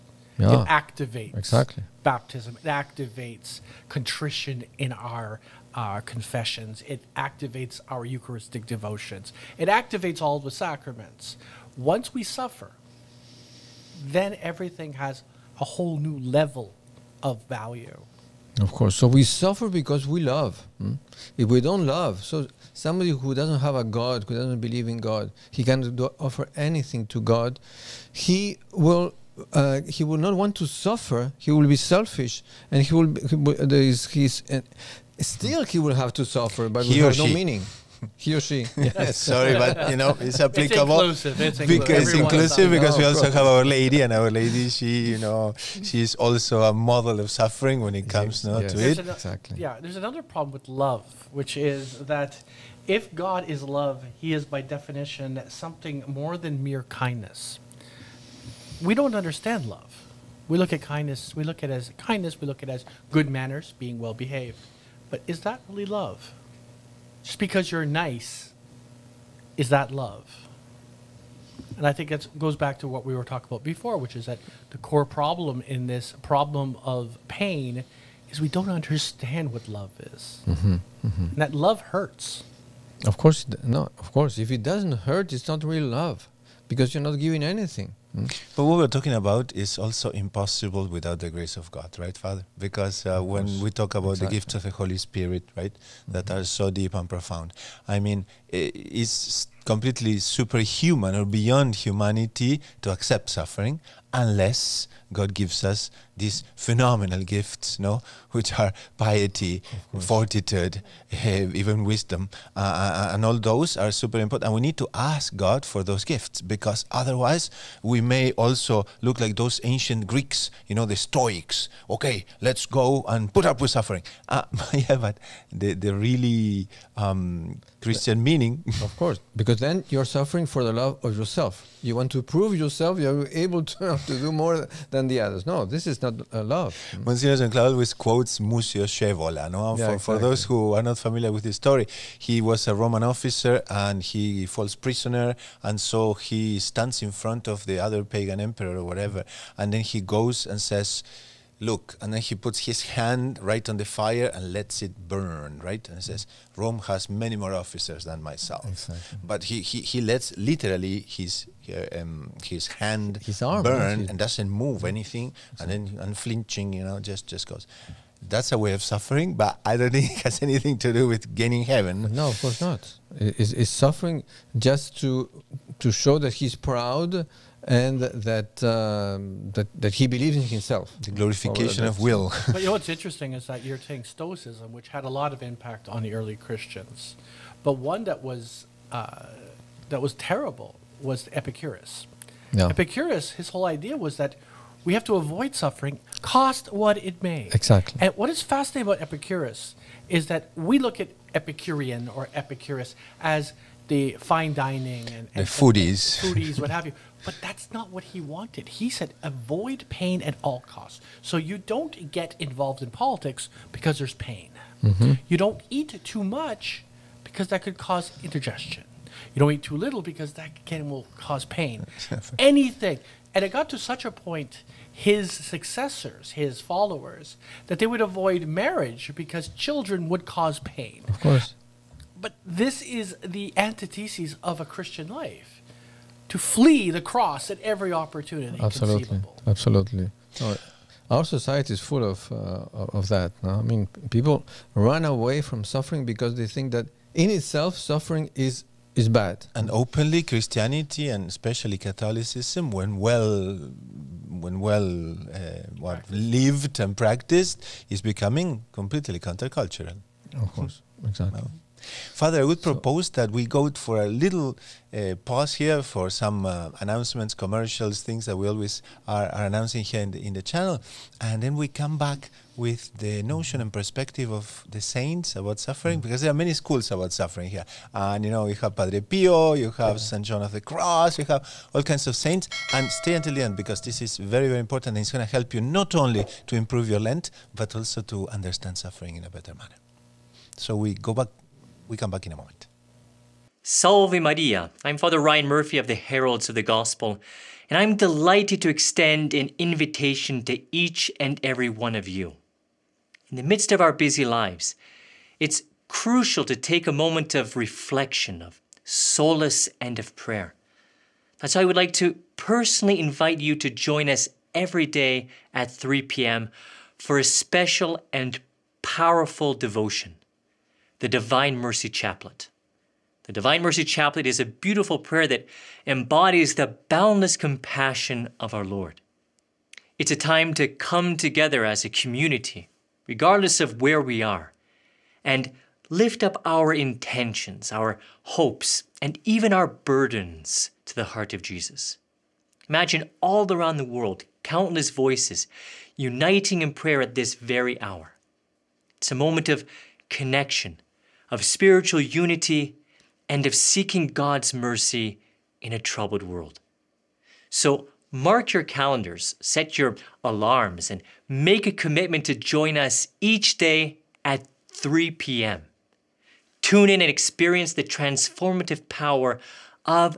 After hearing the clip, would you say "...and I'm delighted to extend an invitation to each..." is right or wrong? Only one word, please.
right.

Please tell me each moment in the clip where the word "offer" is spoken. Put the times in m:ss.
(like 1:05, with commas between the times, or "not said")
0:26.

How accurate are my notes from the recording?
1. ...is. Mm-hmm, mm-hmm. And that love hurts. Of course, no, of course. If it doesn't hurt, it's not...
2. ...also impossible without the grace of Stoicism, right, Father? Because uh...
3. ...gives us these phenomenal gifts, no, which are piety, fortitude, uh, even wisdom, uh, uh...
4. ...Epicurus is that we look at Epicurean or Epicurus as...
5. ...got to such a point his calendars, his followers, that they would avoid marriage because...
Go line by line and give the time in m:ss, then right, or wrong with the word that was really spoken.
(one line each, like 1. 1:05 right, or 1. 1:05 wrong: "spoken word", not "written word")
1. 1:20 right
2. 1:29 wrong: "God", not "Stoicism"
3. 1:45 right
4. 3:19 right
5. 3:43 wrong: "successors", not "calendars".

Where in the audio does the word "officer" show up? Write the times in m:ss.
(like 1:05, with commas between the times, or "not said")
2:23, 2:37.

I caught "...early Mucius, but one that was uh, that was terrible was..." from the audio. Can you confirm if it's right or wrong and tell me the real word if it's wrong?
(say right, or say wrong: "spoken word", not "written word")
wrong: "Christians", not "Mucius".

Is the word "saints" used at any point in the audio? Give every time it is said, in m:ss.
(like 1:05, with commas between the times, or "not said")
4:34, 4:42.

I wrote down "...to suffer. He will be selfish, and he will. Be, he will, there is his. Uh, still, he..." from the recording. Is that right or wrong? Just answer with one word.
right.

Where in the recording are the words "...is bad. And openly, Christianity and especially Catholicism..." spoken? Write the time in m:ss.
4:08.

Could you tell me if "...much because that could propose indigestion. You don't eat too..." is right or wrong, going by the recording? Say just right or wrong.
wrong.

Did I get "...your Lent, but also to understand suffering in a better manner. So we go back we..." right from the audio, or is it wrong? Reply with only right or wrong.
right.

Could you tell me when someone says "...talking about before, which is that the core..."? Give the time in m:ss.
1:13.